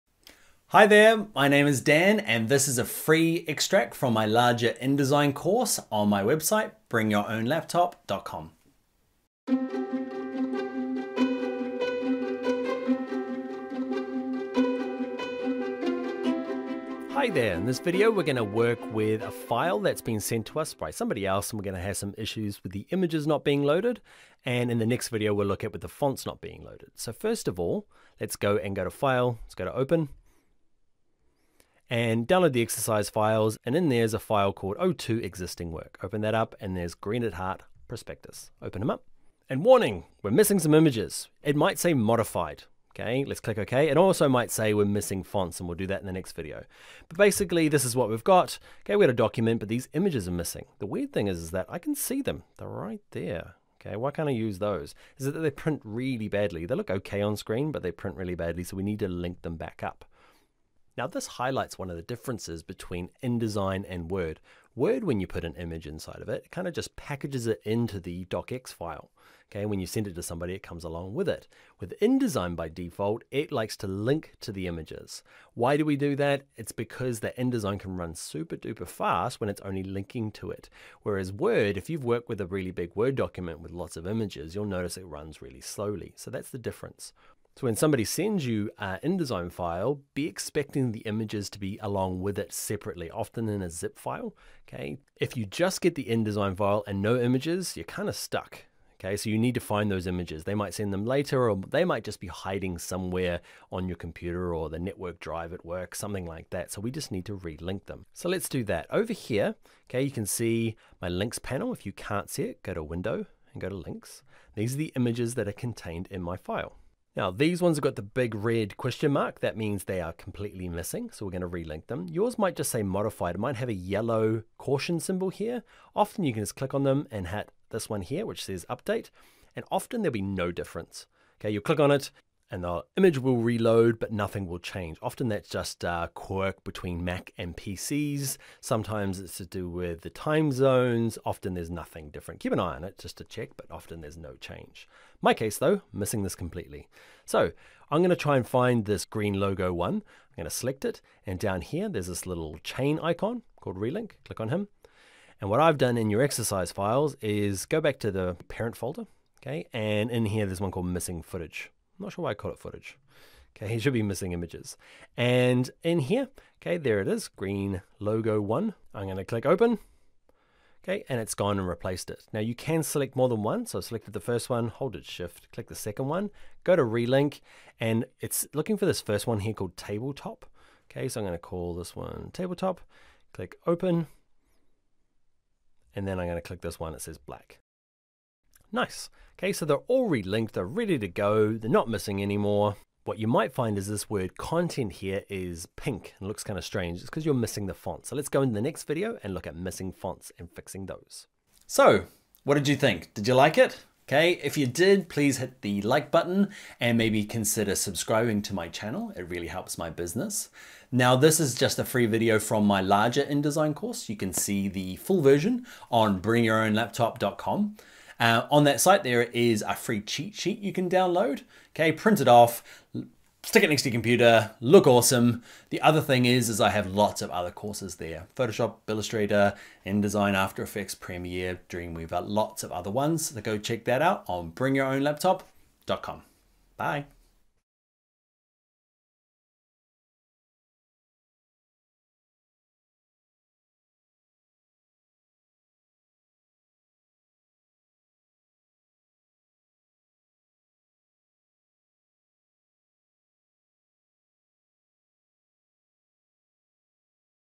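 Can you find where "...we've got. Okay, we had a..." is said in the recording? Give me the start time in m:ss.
0:48.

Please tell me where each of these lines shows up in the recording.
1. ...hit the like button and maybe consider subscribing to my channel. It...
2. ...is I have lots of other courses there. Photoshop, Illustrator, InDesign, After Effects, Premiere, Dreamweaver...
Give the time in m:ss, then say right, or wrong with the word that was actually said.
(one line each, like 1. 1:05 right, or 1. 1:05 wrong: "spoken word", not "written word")
1. 3:25 right
2. 3:46 right.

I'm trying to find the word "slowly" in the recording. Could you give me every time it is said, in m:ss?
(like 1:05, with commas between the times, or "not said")
1:25.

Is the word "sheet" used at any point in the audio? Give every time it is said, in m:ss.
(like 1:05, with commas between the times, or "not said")
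3:40.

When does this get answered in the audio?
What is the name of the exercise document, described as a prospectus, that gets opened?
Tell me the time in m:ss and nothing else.
0:36.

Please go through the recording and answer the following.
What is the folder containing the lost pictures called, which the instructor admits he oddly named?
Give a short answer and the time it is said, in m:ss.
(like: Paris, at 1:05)
missing footage, at 2:40.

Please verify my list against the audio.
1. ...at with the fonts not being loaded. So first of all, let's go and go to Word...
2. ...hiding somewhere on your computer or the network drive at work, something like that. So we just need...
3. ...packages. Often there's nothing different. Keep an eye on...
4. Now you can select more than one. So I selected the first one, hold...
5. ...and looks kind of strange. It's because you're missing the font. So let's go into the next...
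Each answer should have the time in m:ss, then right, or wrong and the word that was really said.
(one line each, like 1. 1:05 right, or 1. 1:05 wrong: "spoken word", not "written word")
1. 0:25 wrong: "File", not "Word"
2. 1:42 right
3. 2:20 wrong: "zones", not "packages"
4. 2:52 right
5. 3:16 right.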